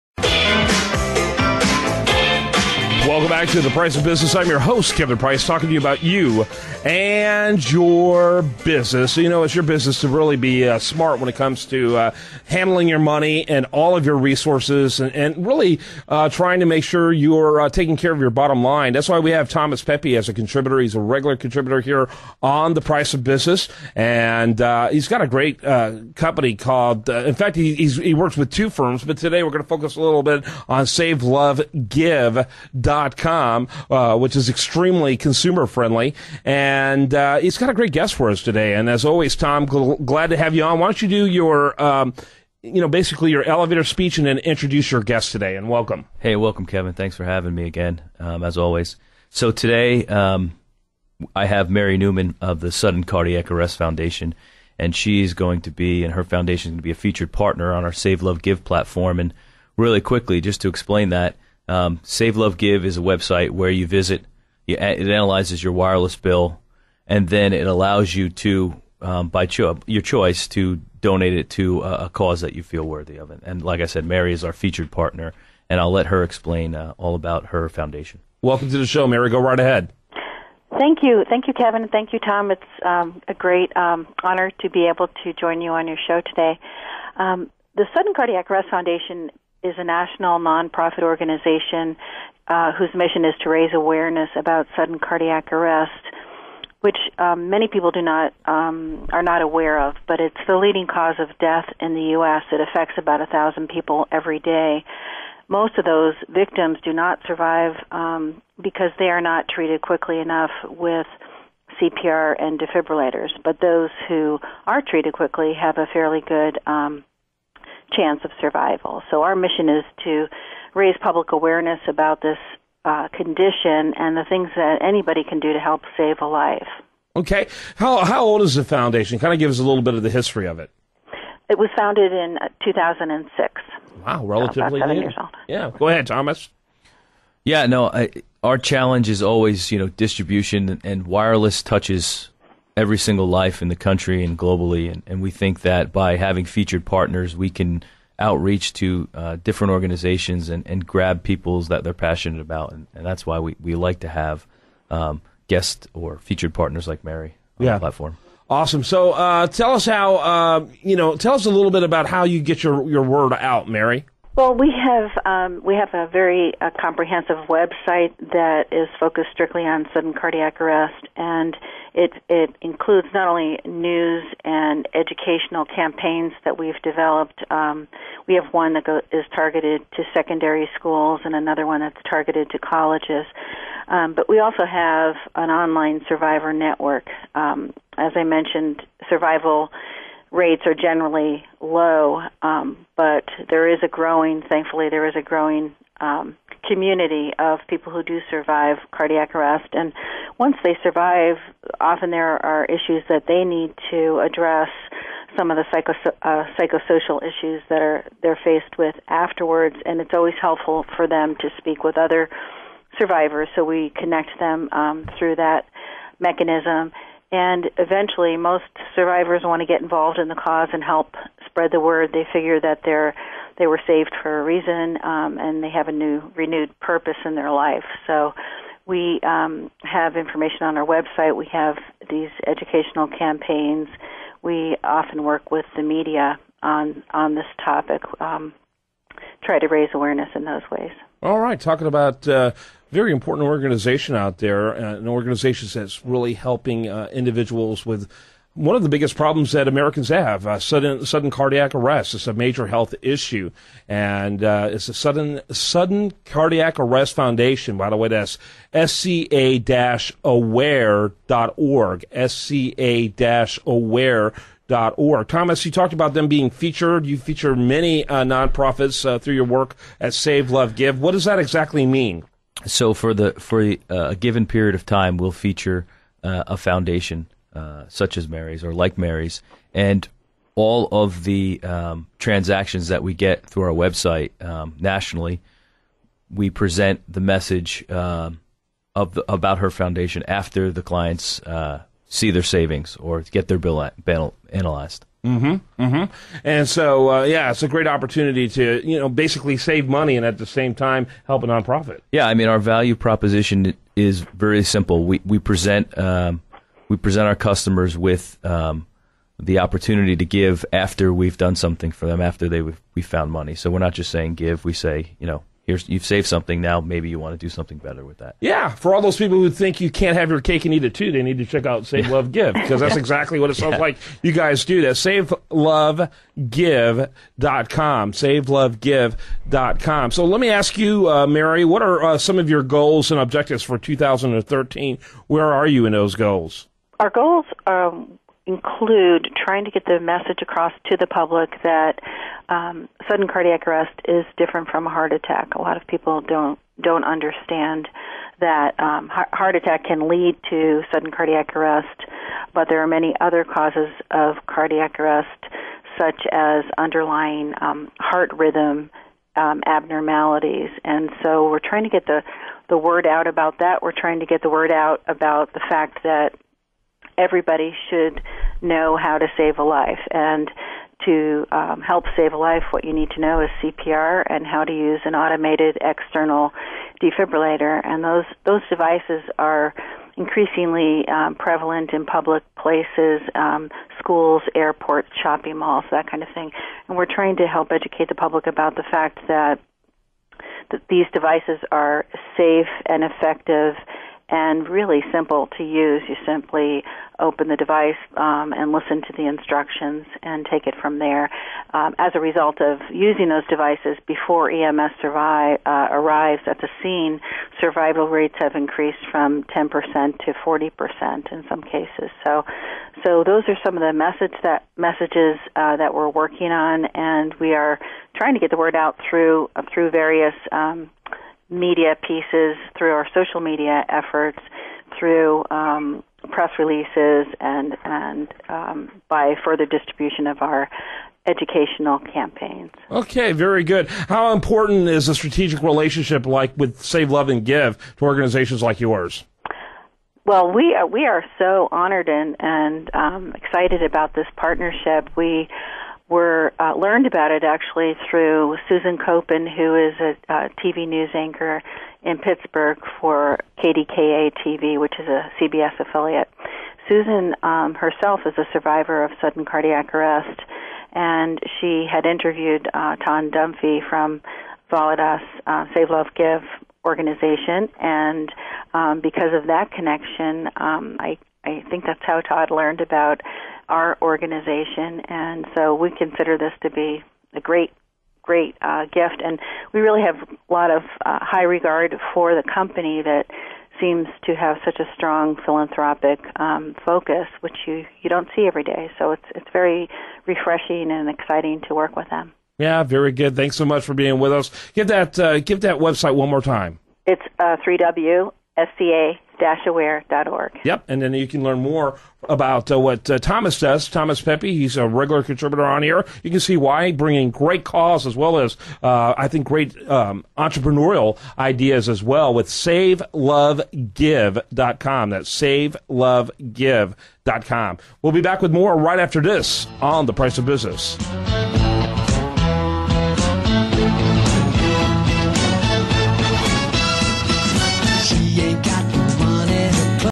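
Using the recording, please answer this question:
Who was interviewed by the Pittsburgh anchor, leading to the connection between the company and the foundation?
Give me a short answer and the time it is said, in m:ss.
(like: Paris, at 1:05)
Todd Dunphy, at 7:42.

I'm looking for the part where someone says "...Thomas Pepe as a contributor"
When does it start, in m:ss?
0:19.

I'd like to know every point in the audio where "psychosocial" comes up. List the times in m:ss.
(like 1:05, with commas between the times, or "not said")
3:26.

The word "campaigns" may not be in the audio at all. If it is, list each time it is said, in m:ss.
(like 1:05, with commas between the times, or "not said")
2:55, 3:53, 7:11.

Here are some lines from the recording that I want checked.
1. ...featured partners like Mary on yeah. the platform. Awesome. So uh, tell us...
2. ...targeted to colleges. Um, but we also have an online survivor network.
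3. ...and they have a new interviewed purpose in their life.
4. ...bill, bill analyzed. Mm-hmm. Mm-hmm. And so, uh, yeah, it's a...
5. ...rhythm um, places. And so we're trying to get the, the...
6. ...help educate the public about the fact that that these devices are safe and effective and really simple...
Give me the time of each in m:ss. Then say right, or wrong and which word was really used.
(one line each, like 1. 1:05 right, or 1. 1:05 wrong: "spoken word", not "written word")
1. 2:36 right
2. 3:02 right
3. 3:45 wrong: "renewed", not "interviewed"
4. 4:53 right
5. 5:58 wrong: "abnormalities", not "places"
6. 6:27 right.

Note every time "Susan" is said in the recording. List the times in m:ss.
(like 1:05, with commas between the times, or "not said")
7:28, 7:36.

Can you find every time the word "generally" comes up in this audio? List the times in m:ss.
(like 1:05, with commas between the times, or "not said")
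3:10.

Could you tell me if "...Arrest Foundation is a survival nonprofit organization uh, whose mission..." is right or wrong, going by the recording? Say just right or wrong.
wrong.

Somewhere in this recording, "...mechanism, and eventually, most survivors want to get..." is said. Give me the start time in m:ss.
3:36.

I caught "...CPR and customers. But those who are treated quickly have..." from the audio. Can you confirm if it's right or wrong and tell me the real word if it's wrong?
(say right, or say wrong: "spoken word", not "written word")
wrong: "defibrillators", not "customers".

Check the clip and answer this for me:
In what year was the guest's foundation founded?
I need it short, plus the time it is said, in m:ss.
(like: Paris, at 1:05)
2006, at 2:12.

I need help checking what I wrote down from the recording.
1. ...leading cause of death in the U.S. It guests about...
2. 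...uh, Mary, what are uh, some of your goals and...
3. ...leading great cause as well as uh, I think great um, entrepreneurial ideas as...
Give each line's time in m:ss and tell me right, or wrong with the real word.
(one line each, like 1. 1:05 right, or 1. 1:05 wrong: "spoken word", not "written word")
1. 1:40 wrong: "affects", not "guests"
2. 5:31 right
3. 8:26 wrong: "bringing", not "leading".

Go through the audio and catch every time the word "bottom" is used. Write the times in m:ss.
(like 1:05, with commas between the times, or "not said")
0:18.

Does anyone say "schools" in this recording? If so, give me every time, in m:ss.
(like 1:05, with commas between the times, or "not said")
3:00, 6:23.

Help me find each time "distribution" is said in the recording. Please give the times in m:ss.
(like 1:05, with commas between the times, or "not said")
2:19, 7:09.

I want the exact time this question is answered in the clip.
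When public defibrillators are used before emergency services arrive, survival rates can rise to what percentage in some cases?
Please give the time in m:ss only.
6:50.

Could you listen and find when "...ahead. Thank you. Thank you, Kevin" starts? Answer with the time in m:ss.
1:19.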